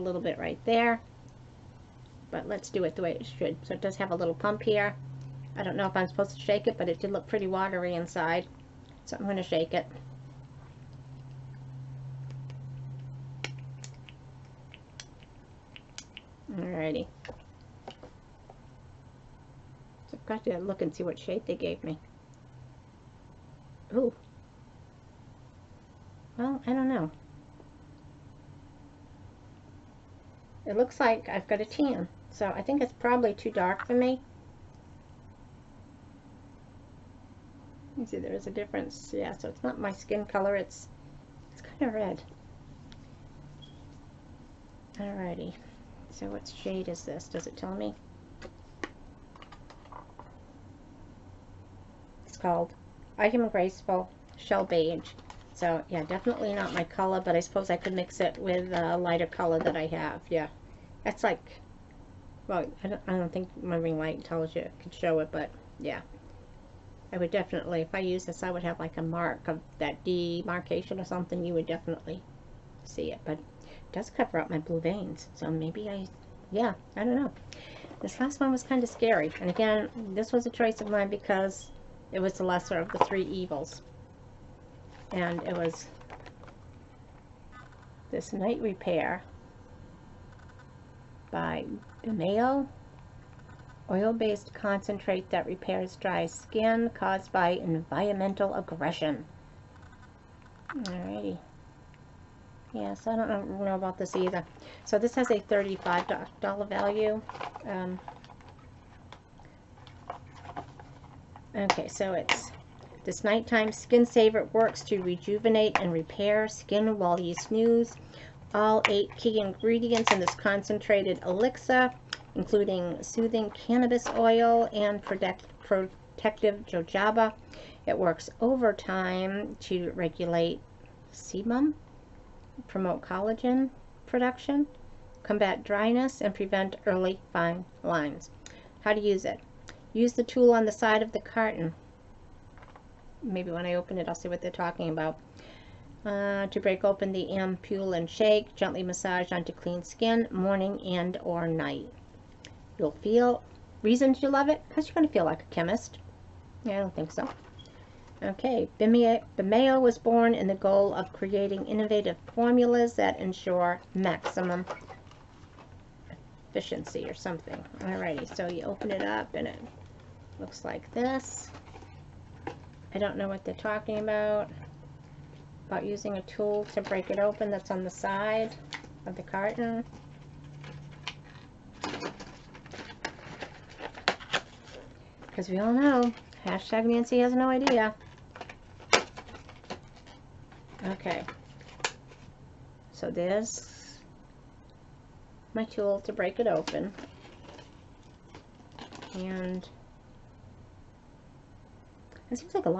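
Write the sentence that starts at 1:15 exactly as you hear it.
So maybe I, yeah, I don't know.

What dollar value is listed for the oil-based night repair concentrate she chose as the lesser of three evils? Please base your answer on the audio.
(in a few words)
$35.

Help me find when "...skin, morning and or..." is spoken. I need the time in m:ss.
2:29.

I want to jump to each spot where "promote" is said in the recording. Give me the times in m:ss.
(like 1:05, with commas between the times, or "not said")
2:12.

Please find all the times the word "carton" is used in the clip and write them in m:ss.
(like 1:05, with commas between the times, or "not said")
2:21, 2:59.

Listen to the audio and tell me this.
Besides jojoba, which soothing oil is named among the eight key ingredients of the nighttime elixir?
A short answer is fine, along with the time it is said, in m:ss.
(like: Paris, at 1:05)
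Cannabis oil, at 2:03.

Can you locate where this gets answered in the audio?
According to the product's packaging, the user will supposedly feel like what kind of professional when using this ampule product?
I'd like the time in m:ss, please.
2:35.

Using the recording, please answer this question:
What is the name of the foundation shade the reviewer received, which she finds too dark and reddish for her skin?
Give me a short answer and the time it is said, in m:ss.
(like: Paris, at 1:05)
I Am Graceful Shell Beige, at 0:53.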